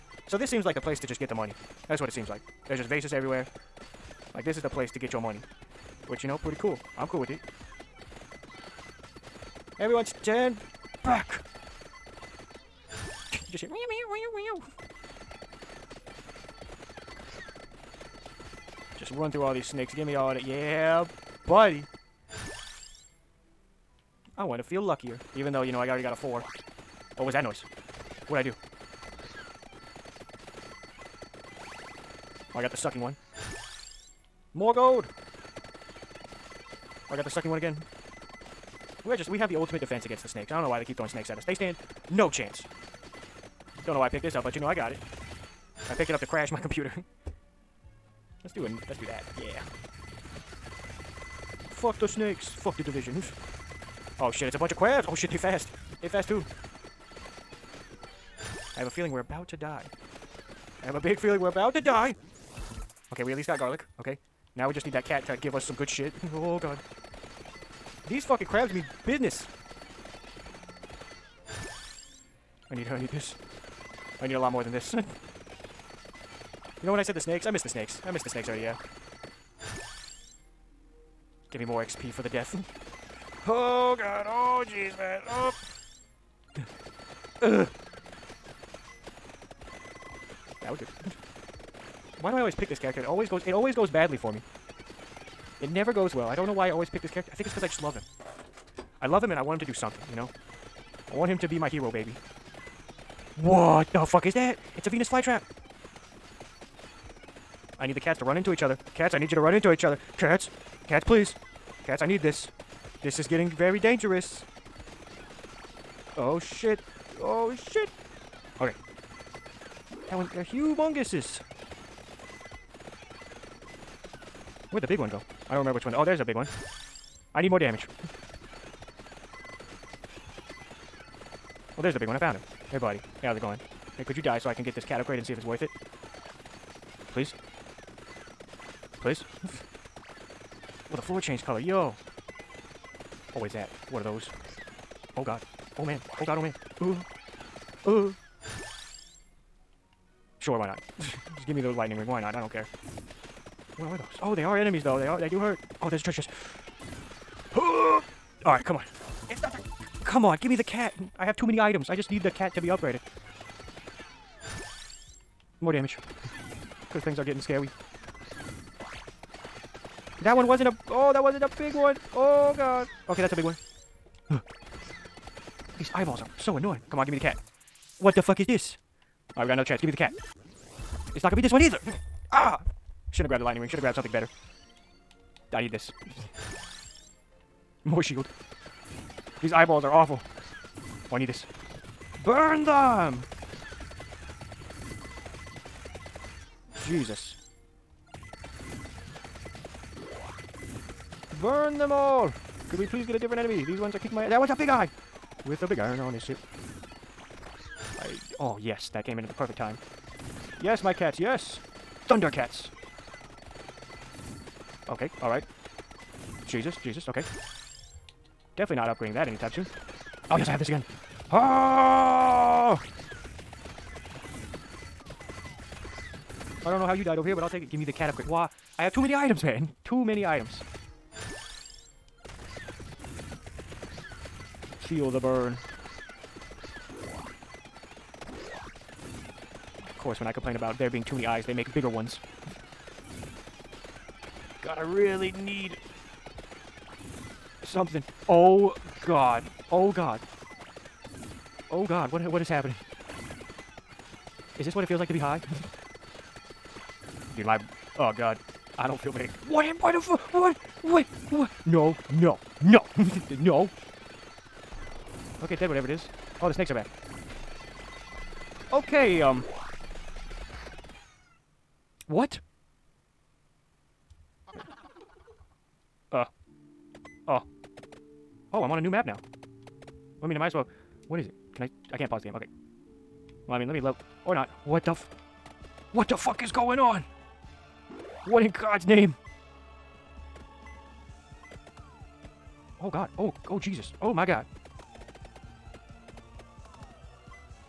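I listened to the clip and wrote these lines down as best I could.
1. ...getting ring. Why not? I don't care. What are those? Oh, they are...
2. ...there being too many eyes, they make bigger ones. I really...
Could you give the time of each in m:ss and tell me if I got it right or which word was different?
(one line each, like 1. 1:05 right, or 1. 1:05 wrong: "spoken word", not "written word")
1. 2:31 wrong: "lightning", not "getting"
2. 4:00 right.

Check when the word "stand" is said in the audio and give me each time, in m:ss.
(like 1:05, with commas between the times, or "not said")
0:10, 0:41.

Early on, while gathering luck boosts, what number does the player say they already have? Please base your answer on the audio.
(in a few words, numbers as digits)
4.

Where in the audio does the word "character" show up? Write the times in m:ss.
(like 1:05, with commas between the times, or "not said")
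1:32, 1:37.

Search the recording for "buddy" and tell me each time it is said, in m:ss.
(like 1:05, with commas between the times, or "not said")
0:21, 2:12.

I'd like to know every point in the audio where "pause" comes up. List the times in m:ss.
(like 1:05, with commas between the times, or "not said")
4:42.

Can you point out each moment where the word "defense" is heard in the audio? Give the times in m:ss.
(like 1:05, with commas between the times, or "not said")
0:39.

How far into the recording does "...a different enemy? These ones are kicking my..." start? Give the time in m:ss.
3:23.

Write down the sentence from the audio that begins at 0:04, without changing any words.
Like, this is the place to get your money.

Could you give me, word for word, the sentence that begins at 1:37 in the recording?
I think it's because I just love him.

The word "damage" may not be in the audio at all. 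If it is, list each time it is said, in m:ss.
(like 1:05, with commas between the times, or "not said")
2:07, 2:45.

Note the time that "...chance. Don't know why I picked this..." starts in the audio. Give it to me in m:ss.
0:42.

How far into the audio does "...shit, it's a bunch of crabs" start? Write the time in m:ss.
0:54.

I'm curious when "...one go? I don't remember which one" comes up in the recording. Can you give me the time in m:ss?
2:04.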